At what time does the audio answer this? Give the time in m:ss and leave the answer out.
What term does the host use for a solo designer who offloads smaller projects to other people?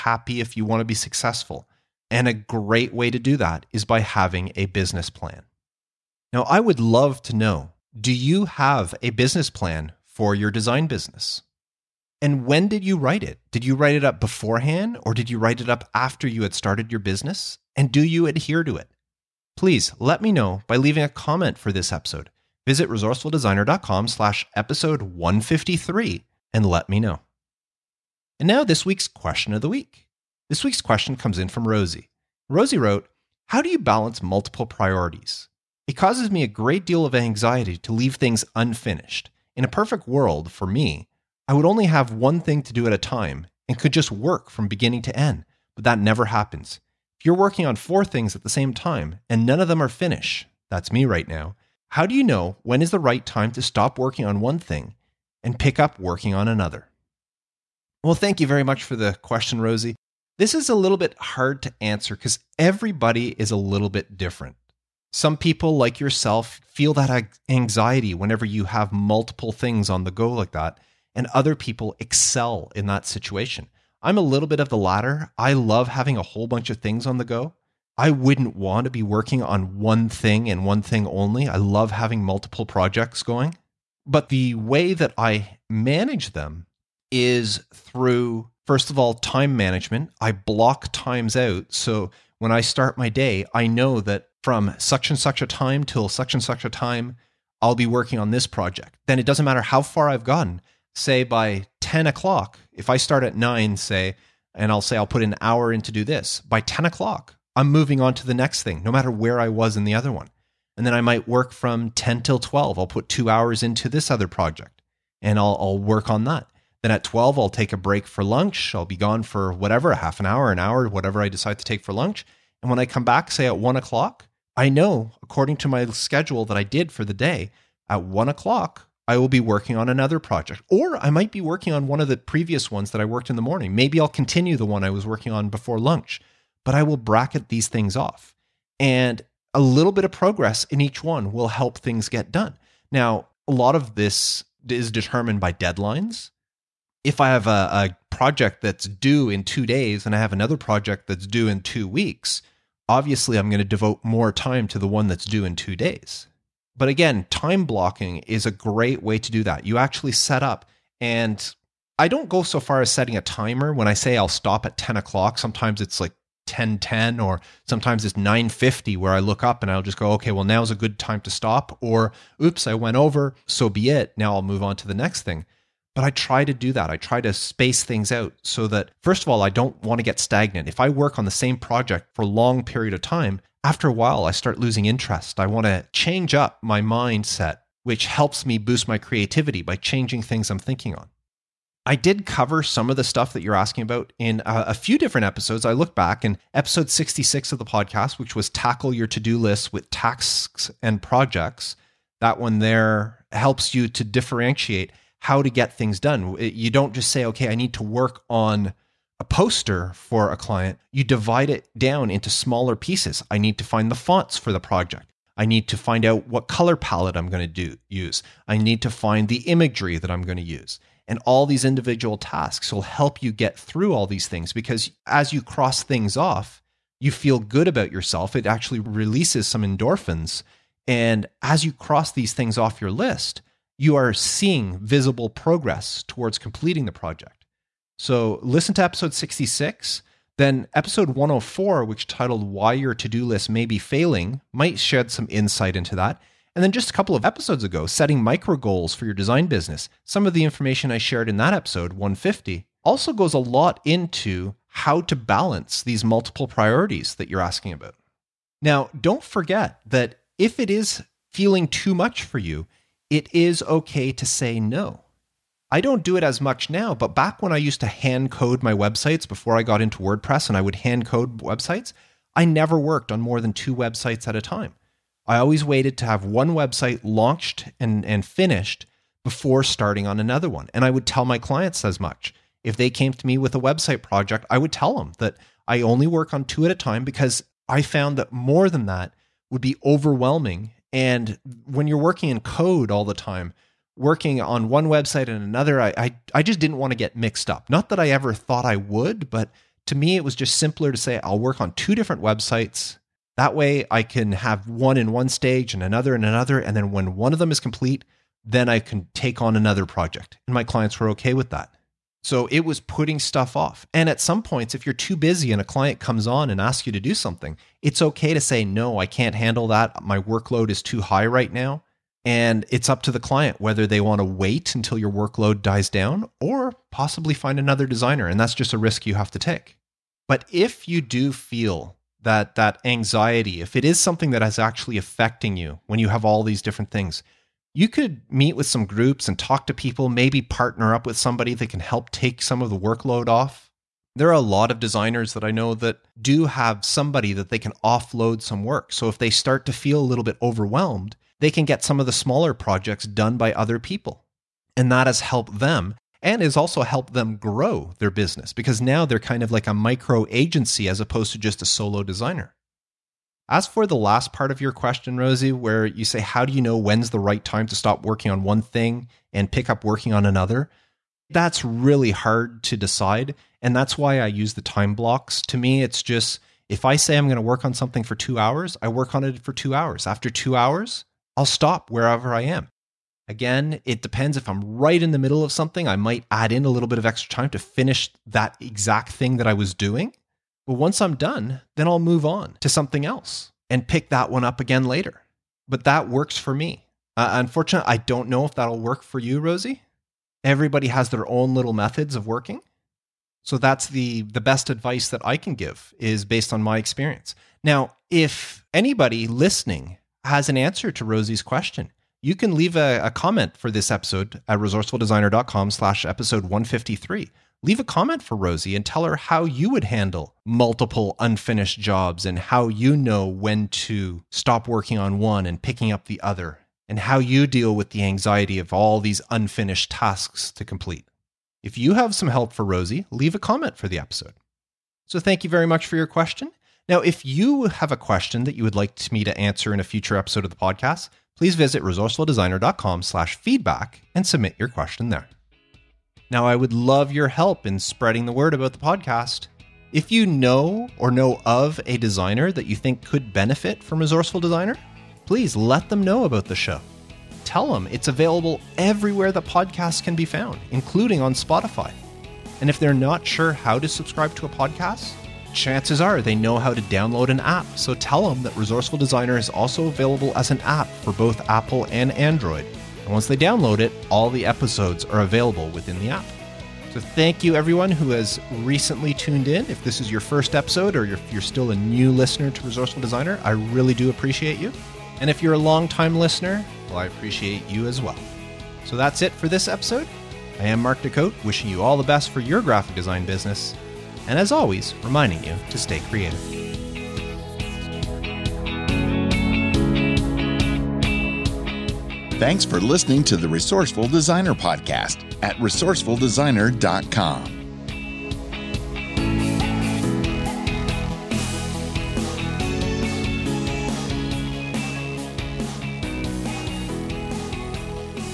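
5:59.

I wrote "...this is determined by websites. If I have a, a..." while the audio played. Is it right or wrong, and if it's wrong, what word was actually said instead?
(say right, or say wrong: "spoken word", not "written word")
wrong: "deadlines", not "websites".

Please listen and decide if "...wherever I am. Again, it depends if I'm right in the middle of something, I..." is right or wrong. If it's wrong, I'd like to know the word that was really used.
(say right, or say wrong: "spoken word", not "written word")
right.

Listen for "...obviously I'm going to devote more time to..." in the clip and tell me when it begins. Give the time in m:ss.
2:32.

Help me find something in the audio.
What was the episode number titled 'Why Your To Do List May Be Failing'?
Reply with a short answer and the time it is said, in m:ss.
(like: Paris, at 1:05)
104, at 4:00.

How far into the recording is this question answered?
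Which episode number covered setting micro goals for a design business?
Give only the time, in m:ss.
4:11.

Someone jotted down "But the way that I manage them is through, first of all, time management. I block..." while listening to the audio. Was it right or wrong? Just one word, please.
right.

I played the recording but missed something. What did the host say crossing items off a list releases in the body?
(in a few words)
endorphins.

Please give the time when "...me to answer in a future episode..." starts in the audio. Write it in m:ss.
7:19.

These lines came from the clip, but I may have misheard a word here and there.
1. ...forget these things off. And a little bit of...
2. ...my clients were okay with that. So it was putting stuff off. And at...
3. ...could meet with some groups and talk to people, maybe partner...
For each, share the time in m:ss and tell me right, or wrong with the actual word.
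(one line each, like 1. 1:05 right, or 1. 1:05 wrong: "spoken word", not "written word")
1. 2:16 wrong: "bracket", not "forget"
2. 5:10 right
3. 5:37 right.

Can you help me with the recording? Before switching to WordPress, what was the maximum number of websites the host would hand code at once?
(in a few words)
2.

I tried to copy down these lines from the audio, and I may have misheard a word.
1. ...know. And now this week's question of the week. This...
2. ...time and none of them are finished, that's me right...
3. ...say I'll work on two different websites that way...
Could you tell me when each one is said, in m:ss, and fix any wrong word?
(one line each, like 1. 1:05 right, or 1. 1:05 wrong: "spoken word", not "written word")
1. 0:26 right
2. 0:48 right
3. 5:00 right.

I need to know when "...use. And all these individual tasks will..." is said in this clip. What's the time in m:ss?
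3:40.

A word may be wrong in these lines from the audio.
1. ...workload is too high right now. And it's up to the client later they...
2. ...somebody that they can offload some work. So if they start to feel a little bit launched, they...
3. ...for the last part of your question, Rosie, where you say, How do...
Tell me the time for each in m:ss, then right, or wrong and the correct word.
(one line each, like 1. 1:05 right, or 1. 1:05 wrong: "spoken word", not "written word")
1. 5:20 wrong: "whether", not "later"
2. 5:46 wrong: "overwhelmed", not "launched"
3. 6:03 right.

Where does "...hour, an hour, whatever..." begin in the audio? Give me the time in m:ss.
2:00.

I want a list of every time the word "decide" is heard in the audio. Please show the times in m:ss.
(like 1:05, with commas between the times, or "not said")
2:01, 6:12.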